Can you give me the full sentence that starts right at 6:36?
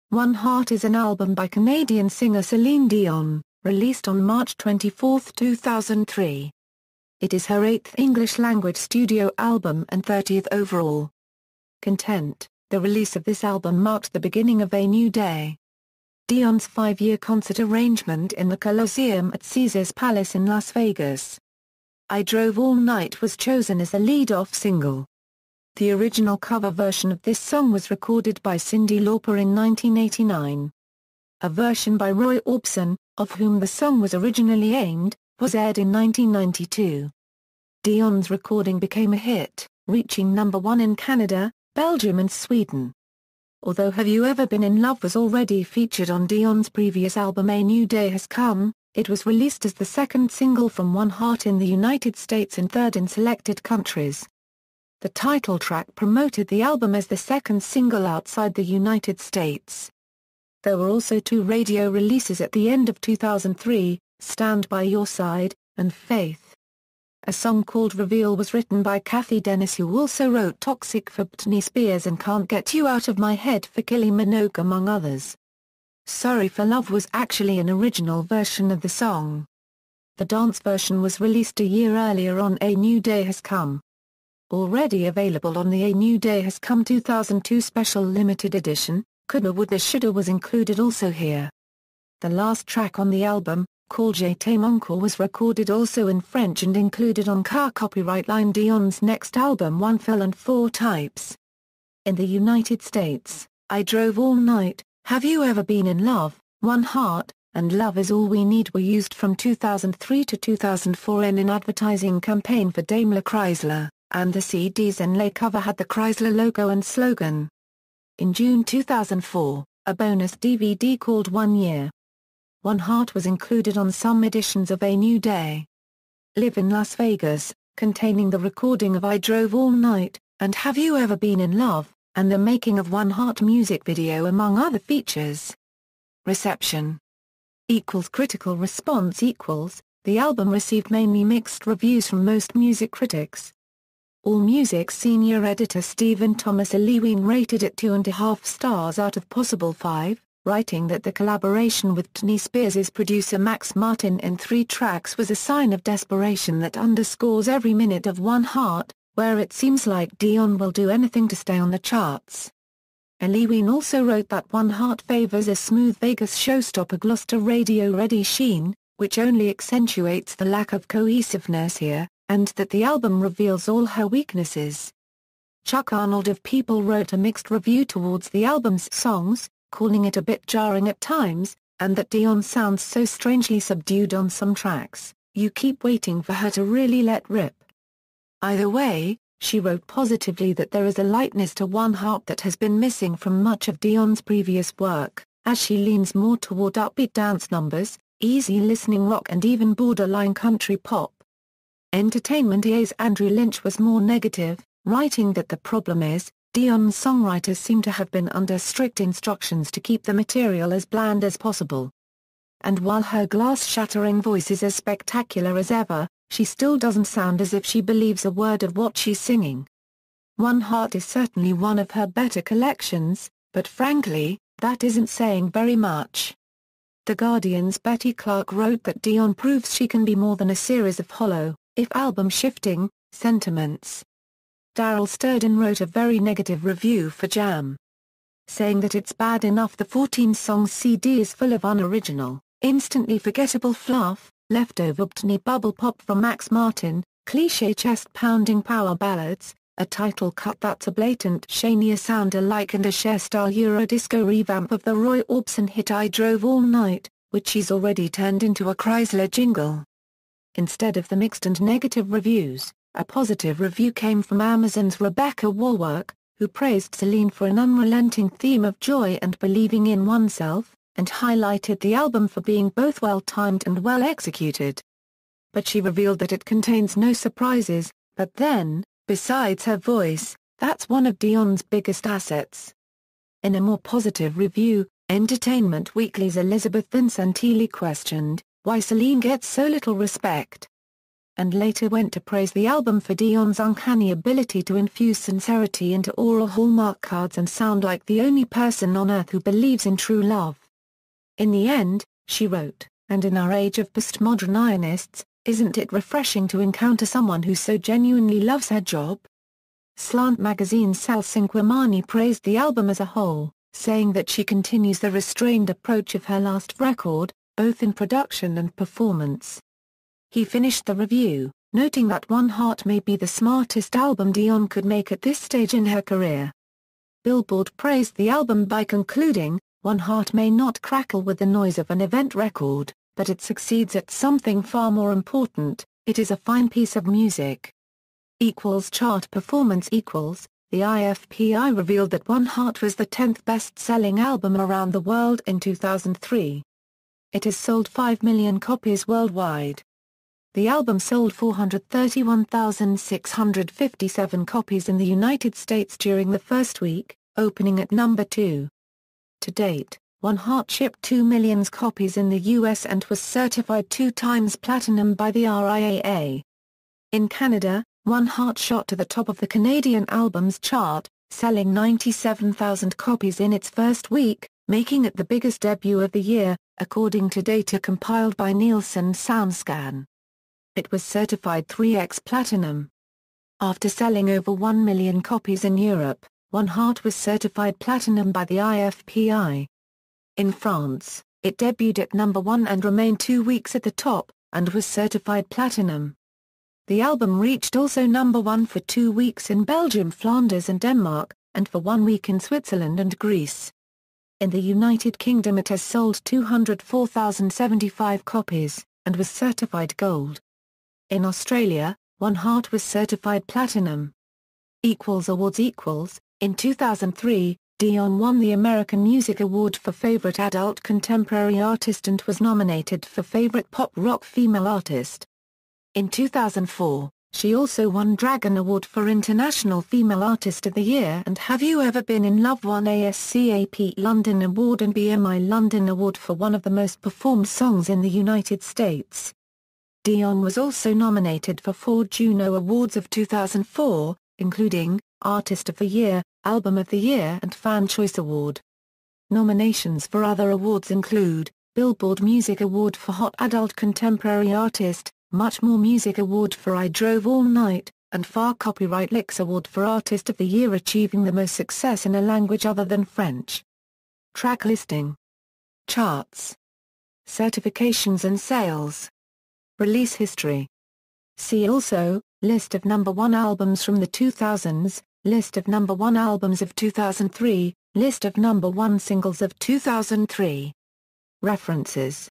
The album reached also number 1 for two weeks in Belgium, Flanders and Denmark, and for one week in Switzerland and Greece.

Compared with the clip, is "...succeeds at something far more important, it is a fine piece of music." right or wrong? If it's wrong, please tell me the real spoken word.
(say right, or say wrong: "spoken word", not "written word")
right.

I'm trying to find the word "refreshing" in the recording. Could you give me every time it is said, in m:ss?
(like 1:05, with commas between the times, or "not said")
5:05.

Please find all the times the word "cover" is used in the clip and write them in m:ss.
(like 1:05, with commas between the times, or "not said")
0:26, 1:55.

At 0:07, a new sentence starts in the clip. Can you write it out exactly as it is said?
It is her eighth English-language studio album and 30th overall.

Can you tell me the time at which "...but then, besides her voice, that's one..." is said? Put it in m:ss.
4:38.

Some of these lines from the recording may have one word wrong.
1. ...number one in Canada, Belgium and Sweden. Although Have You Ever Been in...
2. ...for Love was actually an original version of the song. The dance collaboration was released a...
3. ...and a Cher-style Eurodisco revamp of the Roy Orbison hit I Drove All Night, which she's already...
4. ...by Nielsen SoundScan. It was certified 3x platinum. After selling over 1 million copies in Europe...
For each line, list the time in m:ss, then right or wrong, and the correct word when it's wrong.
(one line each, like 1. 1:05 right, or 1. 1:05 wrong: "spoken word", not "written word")
1. 0:40 right
2. 1:16 wrong: "version", not "collaboration"
3. 4:12 right
4. 6:18 right.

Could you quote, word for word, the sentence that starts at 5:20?
He finished the review, noting that One Heart may be the smartest album Dion could make at this stage in her career.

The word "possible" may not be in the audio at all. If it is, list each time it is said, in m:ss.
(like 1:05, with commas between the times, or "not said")
2:29, 3:31.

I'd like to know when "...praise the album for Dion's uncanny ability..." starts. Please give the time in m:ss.
4:52.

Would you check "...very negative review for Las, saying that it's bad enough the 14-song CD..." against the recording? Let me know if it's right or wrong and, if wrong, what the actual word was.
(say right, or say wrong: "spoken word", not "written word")
wrong: "Jam", not "Las".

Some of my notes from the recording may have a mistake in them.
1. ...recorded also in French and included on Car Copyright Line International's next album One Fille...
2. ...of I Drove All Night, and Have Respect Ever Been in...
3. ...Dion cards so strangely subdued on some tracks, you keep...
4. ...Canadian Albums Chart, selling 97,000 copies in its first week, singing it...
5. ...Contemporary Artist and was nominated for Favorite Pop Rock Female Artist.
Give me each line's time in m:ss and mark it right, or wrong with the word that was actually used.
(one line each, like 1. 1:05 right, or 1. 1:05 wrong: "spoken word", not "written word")
1. 1:35 wrong: "Dion", not "International"
2. 2:08 wrong: "You", not "Respect"
3. 3:02 wrong: "sounds", not "cards"
4. 6:09 wrong: "making", not "singing"
5. 7:00 right.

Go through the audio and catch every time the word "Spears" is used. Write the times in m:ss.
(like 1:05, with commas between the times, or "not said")
1:11, 2:32.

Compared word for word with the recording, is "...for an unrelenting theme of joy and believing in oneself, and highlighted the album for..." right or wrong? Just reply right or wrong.
right.